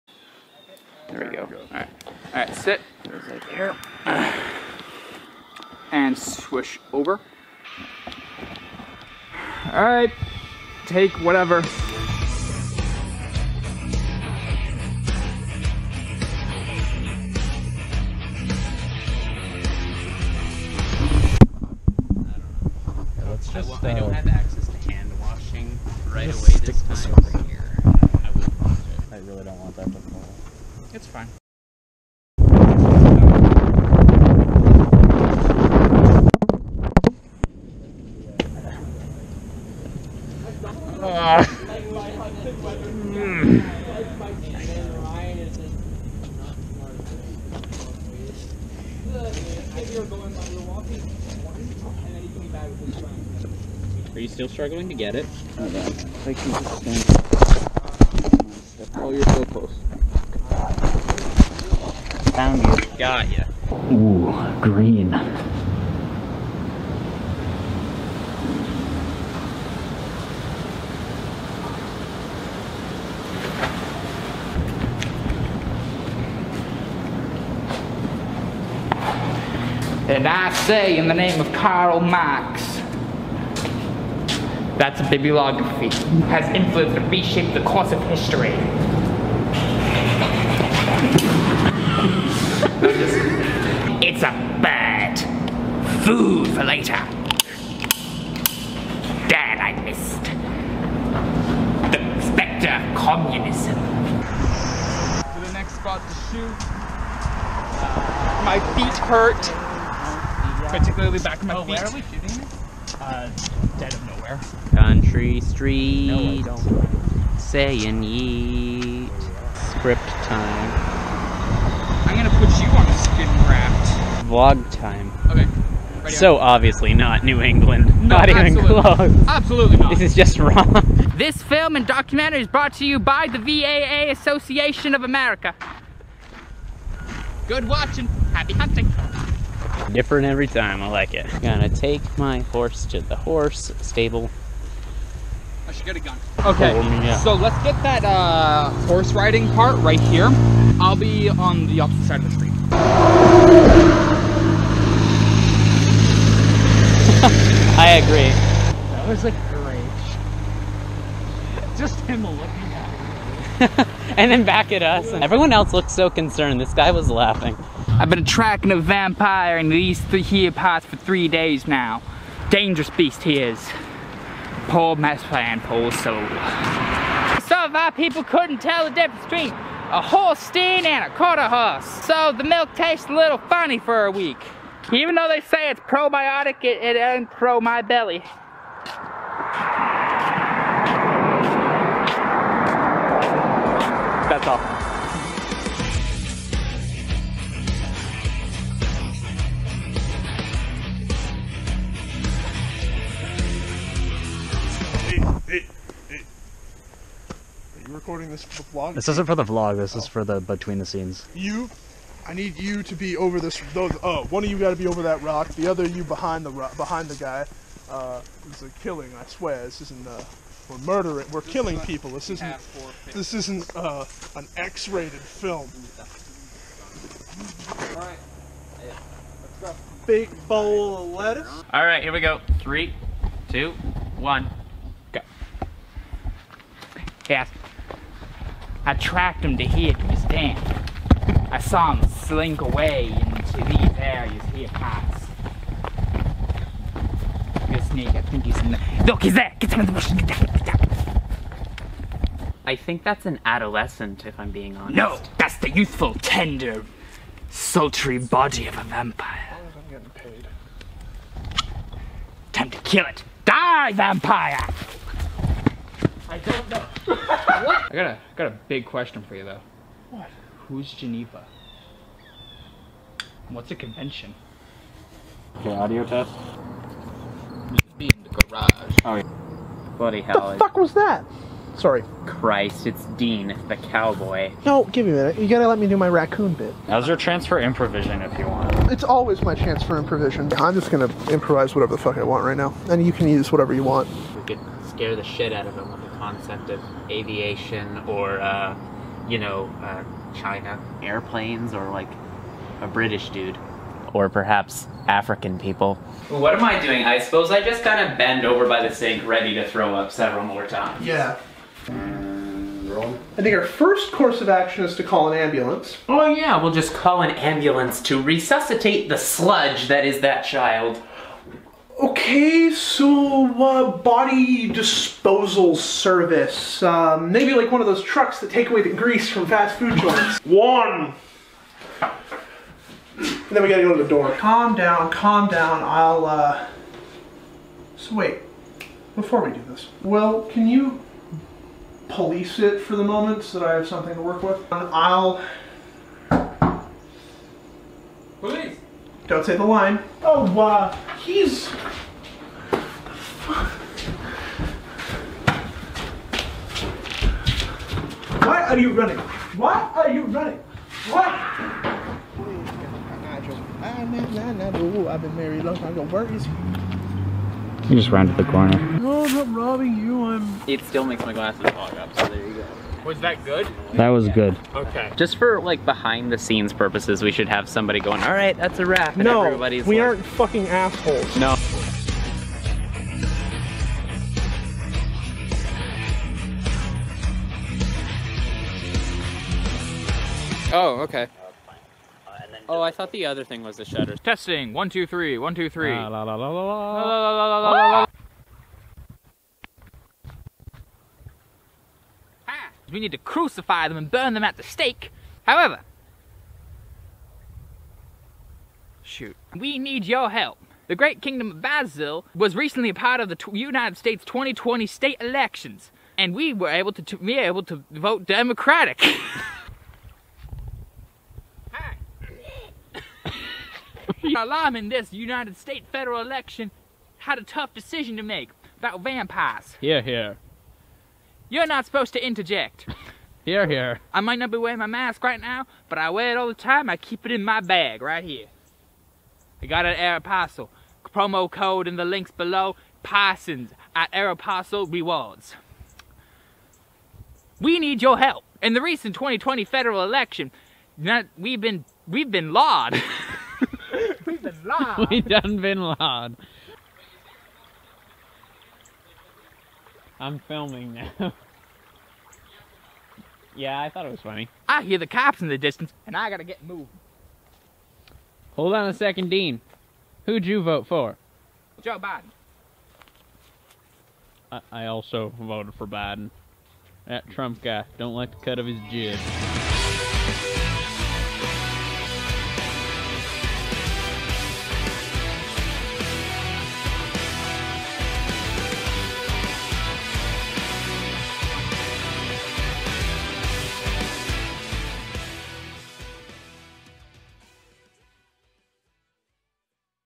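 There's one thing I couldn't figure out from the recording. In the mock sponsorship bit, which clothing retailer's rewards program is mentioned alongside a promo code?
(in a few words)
Aeropostale.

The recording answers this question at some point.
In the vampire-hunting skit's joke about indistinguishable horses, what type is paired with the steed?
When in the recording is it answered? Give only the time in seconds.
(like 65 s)
181 s.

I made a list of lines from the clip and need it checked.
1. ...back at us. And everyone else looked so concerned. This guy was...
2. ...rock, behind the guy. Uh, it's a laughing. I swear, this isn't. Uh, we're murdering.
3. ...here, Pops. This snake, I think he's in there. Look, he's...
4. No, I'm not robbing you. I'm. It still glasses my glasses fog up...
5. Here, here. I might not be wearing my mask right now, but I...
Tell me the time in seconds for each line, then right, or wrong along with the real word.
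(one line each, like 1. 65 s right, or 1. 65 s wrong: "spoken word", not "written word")
1. 164 s right
2. 216 s wrong: "killing", not "laughing"
3. 244 s right
4. 368 s wrong: "makes", not "glasses"
5. 433 s right.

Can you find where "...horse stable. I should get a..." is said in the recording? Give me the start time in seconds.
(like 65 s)
143 s.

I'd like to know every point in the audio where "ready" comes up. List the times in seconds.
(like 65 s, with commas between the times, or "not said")
126 s, 309 s.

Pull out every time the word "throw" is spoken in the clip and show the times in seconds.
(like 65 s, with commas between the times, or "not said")
309 s.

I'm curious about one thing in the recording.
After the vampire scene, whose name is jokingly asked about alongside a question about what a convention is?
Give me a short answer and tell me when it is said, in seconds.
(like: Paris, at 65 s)
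Geneva, at 270 s.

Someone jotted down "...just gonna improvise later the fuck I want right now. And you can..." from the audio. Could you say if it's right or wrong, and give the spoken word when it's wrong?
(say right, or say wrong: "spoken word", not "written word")
wrong: "whatever", not "later".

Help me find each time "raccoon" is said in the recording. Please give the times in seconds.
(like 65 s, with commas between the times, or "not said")
286 s.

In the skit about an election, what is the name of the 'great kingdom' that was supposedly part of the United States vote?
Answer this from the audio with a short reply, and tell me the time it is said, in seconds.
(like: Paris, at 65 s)
Basil, at 411 s.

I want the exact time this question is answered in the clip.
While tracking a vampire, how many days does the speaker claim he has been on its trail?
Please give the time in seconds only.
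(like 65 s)
170 s.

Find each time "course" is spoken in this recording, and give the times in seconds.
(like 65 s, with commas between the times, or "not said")
87 s, 314 s.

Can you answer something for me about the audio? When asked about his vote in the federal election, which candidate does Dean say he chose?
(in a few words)
Joe Biden.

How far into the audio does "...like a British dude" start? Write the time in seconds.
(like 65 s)
301 s.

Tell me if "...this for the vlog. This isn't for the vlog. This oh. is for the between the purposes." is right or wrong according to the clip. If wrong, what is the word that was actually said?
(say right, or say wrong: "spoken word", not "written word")
wrong: "scenes", not "purposes".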